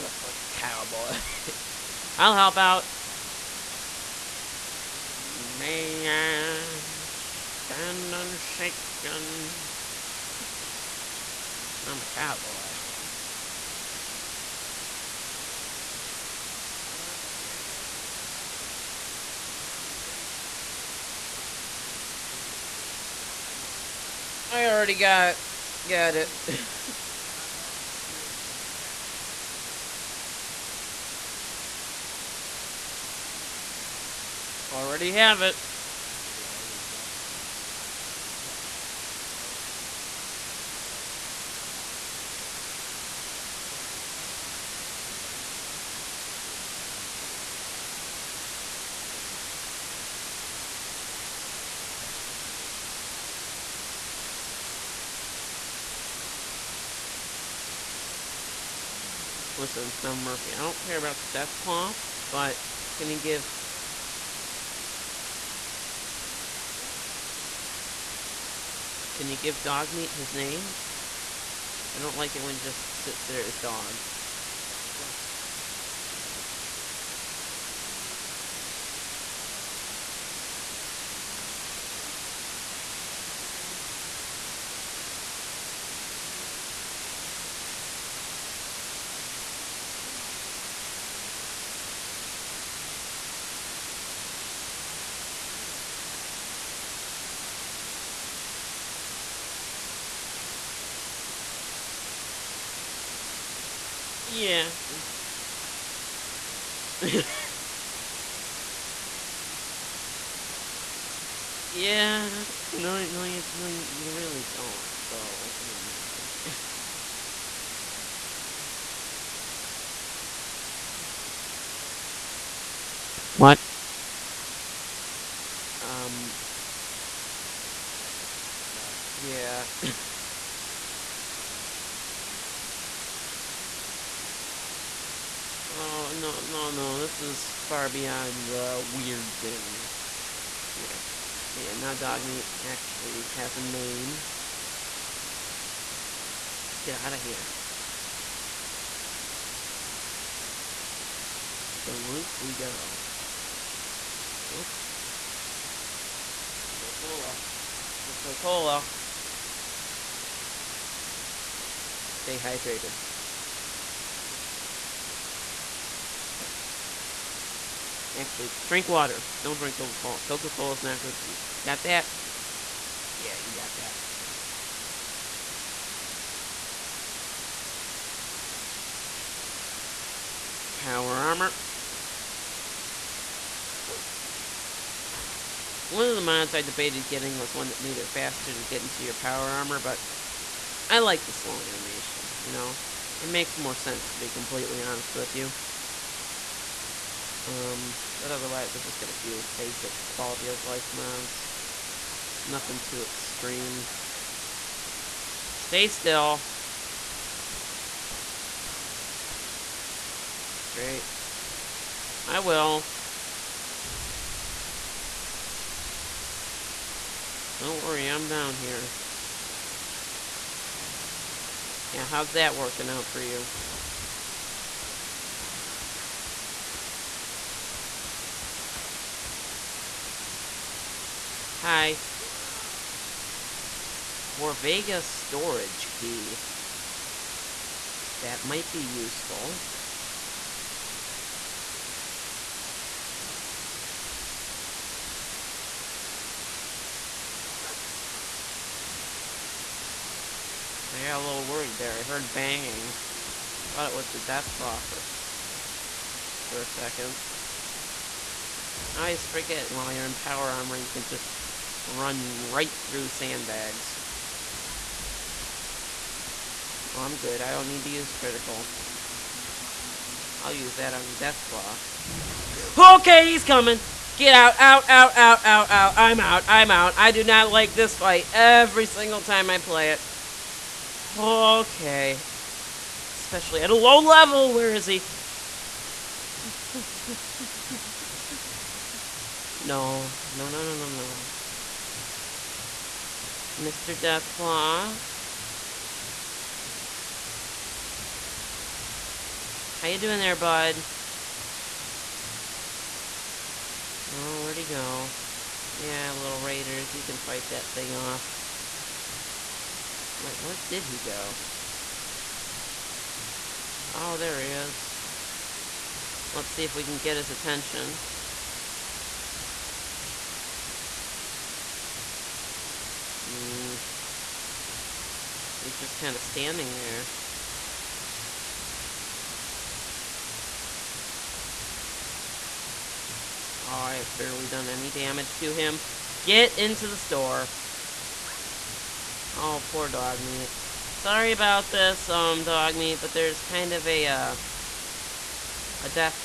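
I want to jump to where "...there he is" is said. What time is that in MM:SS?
05:14.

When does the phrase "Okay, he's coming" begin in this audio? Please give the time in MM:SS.
04:32.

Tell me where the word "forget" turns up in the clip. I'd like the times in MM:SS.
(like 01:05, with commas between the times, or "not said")
02:12, 04:19.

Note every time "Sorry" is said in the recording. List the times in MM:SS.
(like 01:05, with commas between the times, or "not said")
05:40.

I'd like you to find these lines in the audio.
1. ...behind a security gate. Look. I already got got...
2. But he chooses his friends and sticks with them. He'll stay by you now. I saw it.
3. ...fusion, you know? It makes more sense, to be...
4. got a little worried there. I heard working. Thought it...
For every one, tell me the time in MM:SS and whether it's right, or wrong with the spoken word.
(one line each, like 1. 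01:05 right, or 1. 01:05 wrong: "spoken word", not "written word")
1. 00:21 right
2. 01:29 right
3. 03:11 wrong: "animation", not "fusion"
4. 04:11 wrong: "banging", not "working".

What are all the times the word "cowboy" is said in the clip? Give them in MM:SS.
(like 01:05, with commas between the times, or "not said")
00:00, 00:12.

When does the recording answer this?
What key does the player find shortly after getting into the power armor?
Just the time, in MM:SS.
03:54.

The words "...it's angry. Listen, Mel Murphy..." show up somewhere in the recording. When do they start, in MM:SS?
00:58.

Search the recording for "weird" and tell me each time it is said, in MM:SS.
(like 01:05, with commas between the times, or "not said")
02:14, 02:18.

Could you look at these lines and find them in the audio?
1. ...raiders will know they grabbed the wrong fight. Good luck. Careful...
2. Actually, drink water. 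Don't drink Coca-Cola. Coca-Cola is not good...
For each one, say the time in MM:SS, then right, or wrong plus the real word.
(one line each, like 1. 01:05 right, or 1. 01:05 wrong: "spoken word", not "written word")
1. 00:46 wrong: "picked", not "grabbed"
2. 02:48 right.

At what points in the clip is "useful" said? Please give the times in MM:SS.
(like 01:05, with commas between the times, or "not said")
03:58.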